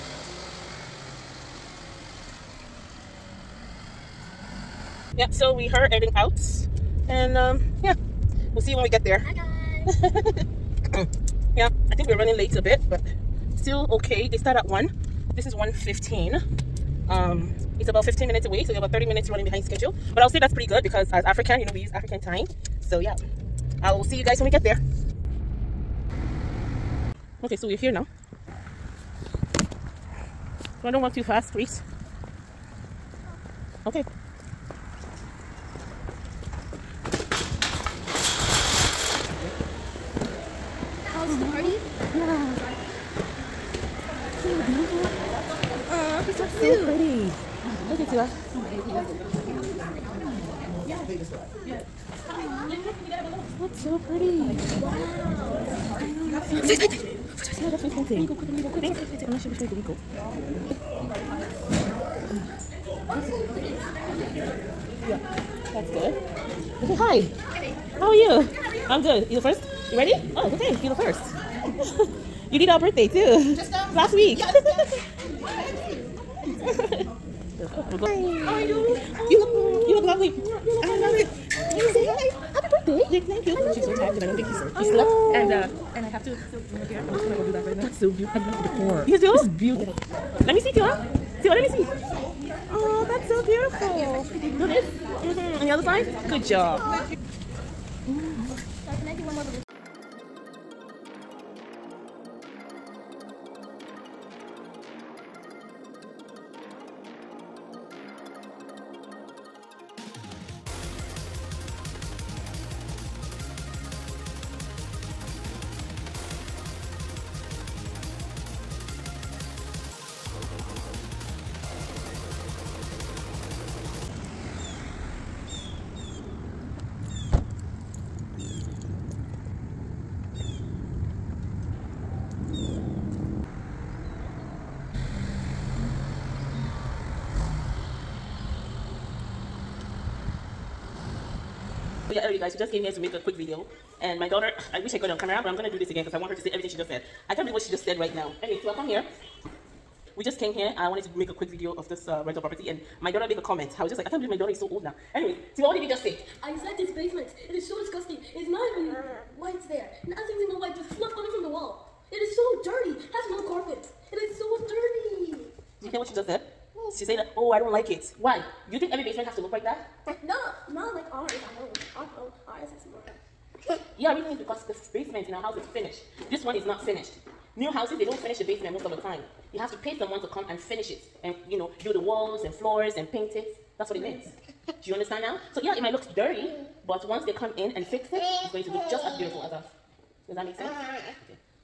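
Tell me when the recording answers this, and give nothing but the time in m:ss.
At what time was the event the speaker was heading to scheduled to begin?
0:14.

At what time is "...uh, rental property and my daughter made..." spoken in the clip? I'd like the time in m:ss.
2:32.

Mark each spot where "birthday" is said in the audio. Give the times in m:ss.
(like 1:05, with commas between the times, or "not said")
1:12, 1:22.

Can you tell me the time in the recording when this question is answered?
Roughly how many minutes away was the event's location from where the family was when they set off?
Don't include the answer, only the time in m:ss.
0:17.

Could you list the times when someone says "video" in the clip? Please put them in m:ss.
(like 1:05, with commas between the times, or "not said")
2:23, 2:31.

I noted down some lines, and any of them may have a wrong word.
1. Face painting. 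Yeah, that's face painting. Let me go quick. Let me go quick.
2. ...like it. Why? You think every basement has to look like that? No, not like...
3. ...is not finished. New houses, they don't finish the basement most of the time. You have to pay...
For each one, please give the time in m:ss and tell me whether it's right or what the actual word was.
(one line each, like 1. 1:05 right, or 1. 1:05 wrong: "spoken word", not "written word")
1. 0:56 right
2. 2:47 right
3. 2:56 right.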